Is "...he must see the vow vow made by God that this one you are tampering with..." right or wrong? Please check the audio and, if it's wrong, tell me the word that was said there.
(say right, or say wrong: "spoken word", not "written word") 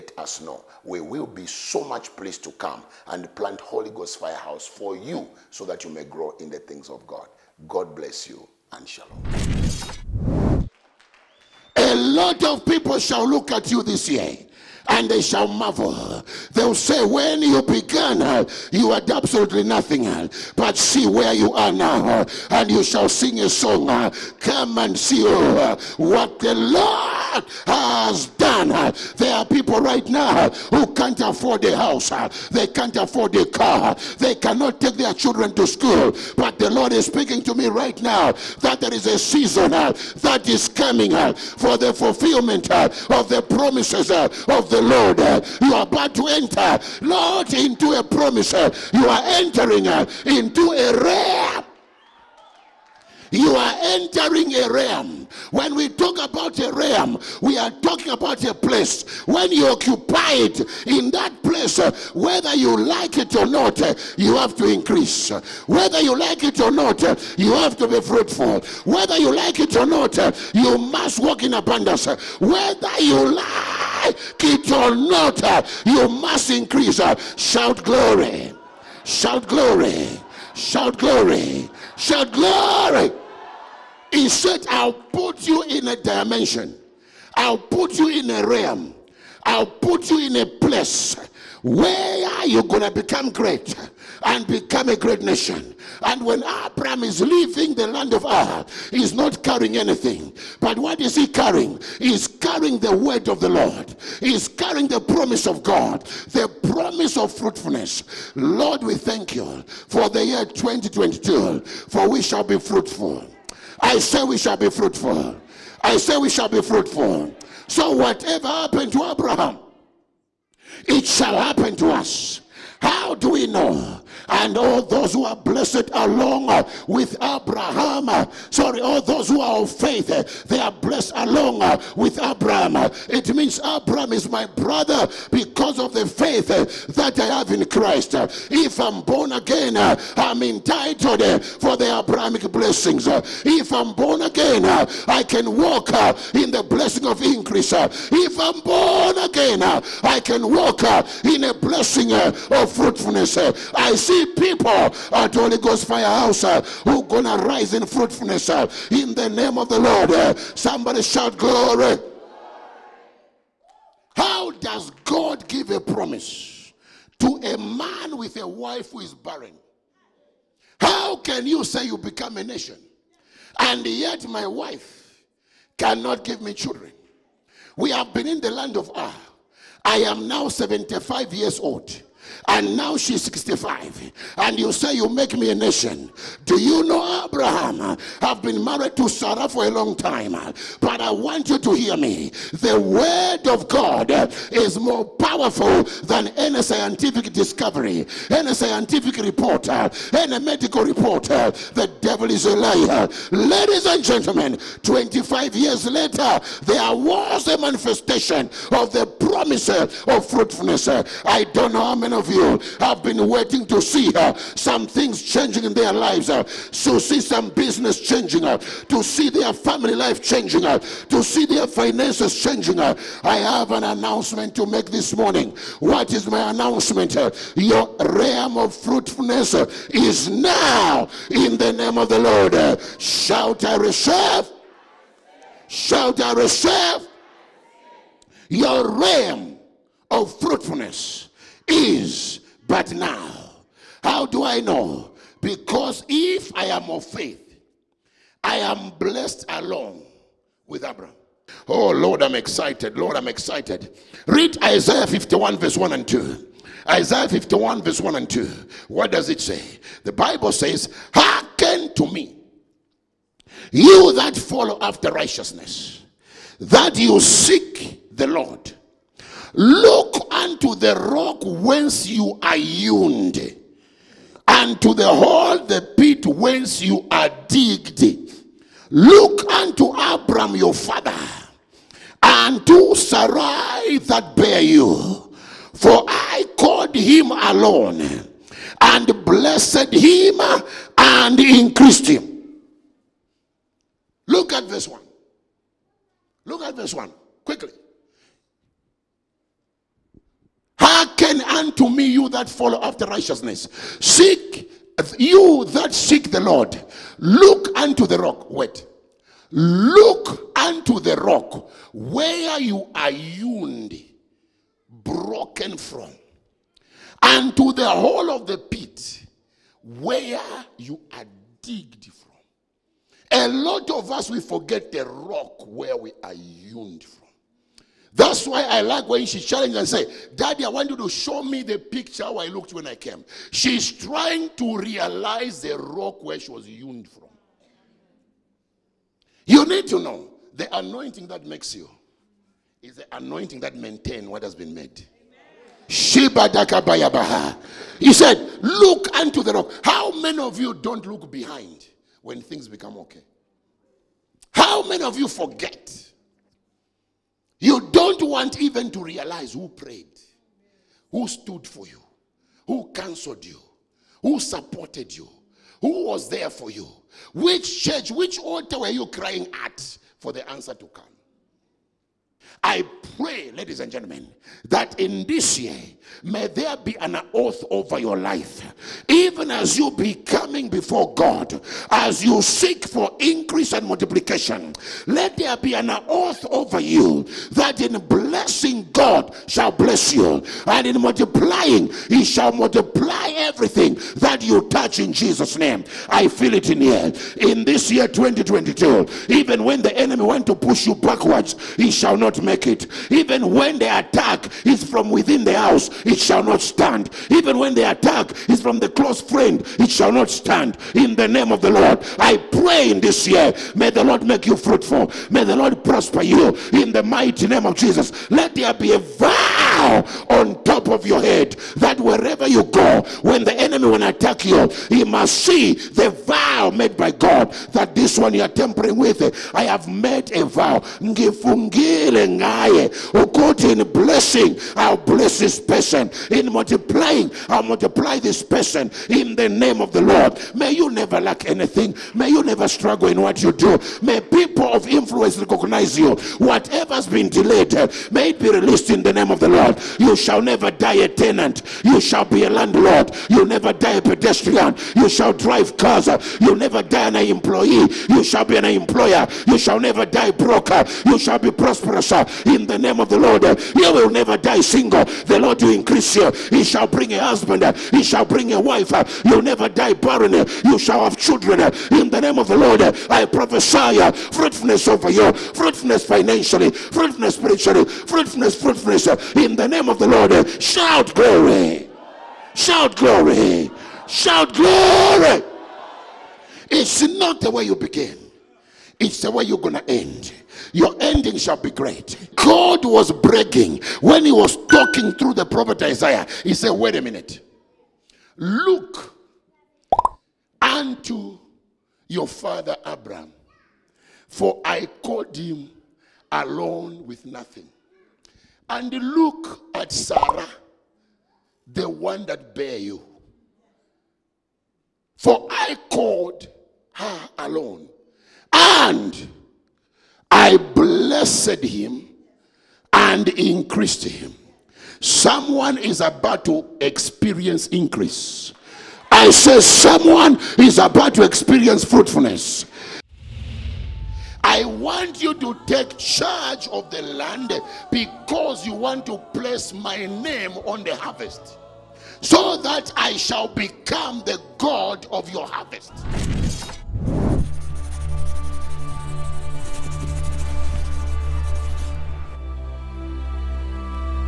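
right.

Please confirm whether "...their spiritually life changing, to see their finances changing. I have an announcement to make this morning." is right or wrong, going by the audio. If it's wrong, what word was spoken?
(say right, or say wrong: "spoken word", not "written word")
wrong: "family", not "spiritually".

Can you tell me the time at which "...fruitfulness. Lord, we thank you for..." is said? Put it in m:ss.
1:47.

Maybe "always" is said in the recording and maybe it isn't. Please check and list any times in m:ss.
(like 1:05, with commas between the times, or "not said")
not said.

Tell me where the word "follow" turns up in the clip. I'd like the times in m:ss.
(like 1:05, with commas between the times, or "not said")
4:24, 5:02.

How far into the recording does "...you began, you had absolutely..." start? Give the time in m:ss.
0:17.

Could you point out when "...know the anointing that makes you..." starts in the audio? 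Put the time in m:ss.
5:39.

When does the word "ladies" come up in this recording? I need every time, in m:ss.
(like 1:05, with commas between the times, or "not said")
3:23, 6:13.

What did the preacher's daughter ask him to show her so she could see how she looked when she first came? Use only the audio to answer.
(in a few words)
The picture.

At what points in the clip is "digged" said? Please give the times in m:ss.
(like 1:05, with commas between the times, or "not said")
4:37, 5:21.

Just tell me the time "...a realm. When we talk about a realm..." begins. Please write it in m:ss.
0:54.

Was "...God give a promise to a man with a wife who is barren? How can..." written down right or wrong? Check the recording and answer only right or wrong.
right.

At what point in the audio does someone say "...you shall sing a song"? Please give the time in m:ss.
0:22.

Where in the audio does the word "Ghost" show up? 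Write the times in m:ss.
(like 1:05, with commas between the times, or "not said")
0:03, 2:35.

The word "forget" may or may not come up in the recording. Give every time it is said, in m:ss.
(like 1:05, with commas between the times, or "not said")
5:24, 5:55.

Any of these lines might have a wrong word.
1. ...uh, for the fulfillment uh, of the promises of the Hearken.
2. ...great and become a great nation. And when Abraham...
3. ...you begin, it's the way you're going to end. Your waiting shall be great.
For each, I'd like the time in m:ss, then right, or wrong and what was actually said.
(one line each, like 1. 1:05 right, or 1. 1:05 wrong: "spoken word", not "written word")
1. 0:41 wrong: "Lord", not "Hearken"
2. 1:33 right
3. 8:07 wrong: "ending", not "waiting".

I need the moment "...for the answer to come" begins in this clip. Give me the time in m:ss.
6:10.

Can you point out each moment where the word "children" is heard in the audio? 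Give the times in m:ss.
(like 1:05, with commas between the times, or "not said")
0:35, 2:56, 7:51.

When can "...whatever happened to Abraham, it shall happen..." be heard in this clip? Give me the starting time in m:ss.
1:57.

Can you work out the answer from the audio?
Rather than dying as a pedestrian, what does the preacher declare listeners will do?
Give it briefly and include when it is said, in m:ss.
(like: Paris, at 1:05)
Drive cars, at 7:35.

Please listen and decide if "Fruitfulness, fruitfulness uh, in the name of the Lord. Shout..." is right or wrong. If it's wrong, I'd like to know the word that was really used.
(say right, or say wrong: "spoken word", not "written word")
right.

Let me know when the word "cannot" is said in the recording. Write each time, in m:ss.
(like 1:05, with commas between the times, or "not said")
0:34, 2:55.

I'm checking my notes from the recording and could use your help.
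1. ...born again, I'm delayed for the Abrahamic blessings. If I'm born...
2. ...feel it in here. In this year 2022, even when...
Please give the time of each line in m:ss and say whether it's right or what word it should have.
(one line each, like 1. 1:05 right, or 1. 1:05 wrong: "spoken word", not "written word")
1. 2:19 wrong: "entitled", not "delayed"
2. 6:36 right.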